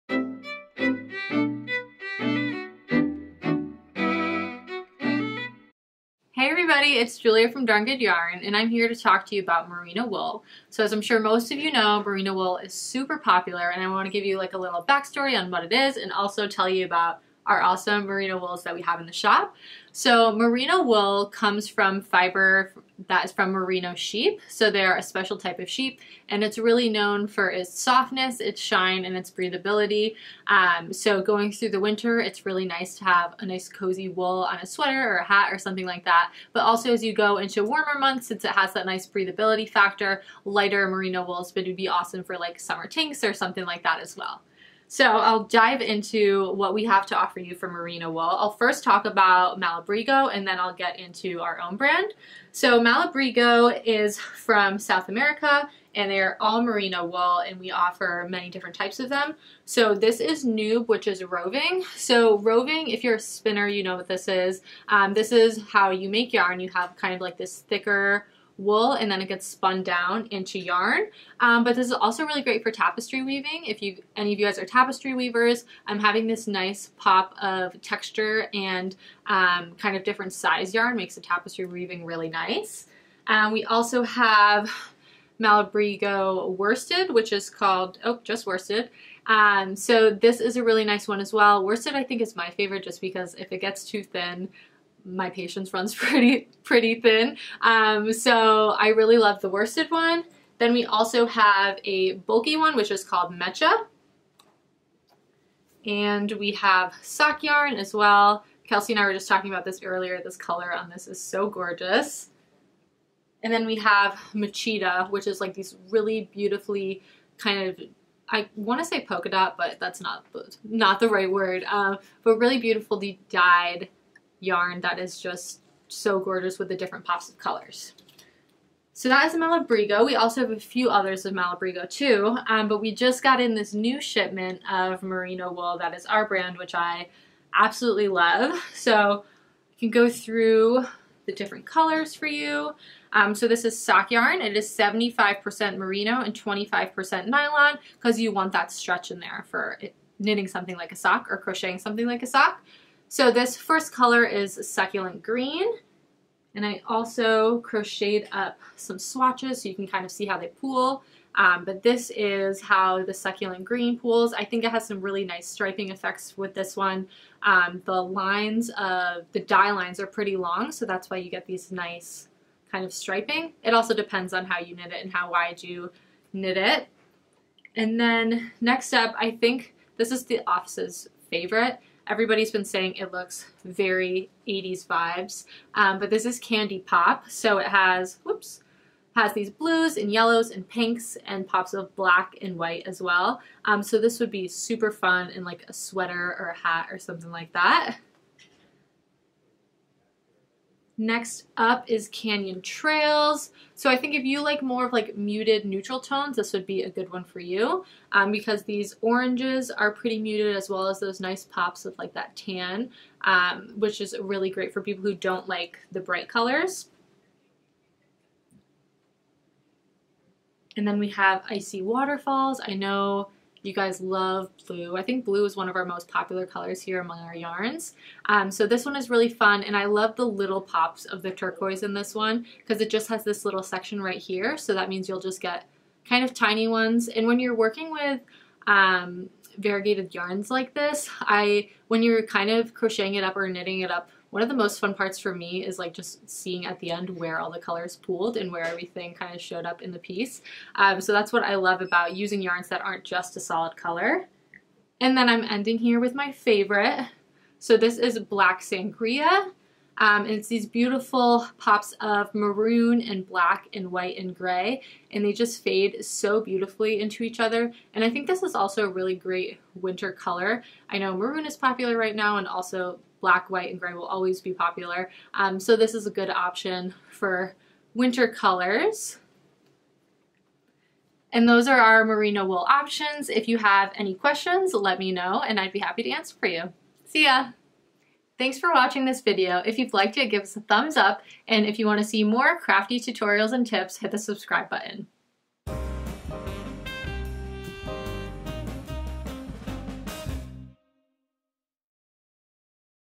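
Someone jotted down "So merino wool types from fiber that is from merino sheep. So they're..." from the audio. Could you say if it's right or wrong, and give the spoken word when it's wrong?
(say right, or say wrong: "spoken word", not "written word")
wrong: "comes", not "types".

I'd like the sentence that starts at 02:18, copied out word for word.
So I can go through the different colors for you.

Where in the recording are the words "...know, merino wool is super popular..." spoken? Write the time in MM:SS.
00:11.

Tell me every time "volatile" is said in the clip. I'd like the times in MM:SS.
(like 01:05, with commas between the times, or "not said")
not said.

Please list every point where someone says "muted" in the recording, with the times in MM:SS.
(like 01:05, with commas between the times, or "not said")
03:25, 03:30.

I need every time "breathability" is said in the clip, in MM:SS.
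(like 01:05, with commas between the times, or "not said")
00:29, 00:39.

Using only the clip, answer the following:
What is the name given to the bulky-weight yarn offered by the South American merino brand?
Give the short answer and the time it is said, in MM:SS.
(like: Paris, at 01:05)
Mecha, at 01:43.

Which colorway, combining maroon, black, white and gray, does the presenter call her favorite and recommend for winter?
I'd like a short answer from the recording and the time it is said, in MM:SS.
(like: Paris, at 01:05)
Black Sangria, at 04:18.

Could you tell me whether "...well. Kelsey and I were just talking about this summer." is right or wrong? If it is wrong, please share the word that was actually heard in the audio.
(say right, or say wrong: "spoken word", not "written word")
wrong: "earlier", not "summer".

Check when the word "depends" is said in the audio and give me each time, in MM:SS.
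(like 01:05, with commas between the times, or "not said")
02:53.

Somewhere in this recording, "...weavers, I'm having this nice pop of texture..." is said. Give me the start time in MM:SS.
01:15.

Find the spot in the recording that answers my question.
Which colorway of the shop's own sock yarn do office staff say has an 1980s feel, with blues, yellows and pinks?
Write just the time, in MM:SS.
03:06.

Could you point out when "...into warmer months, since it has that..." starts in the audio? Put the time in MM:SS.
00:37.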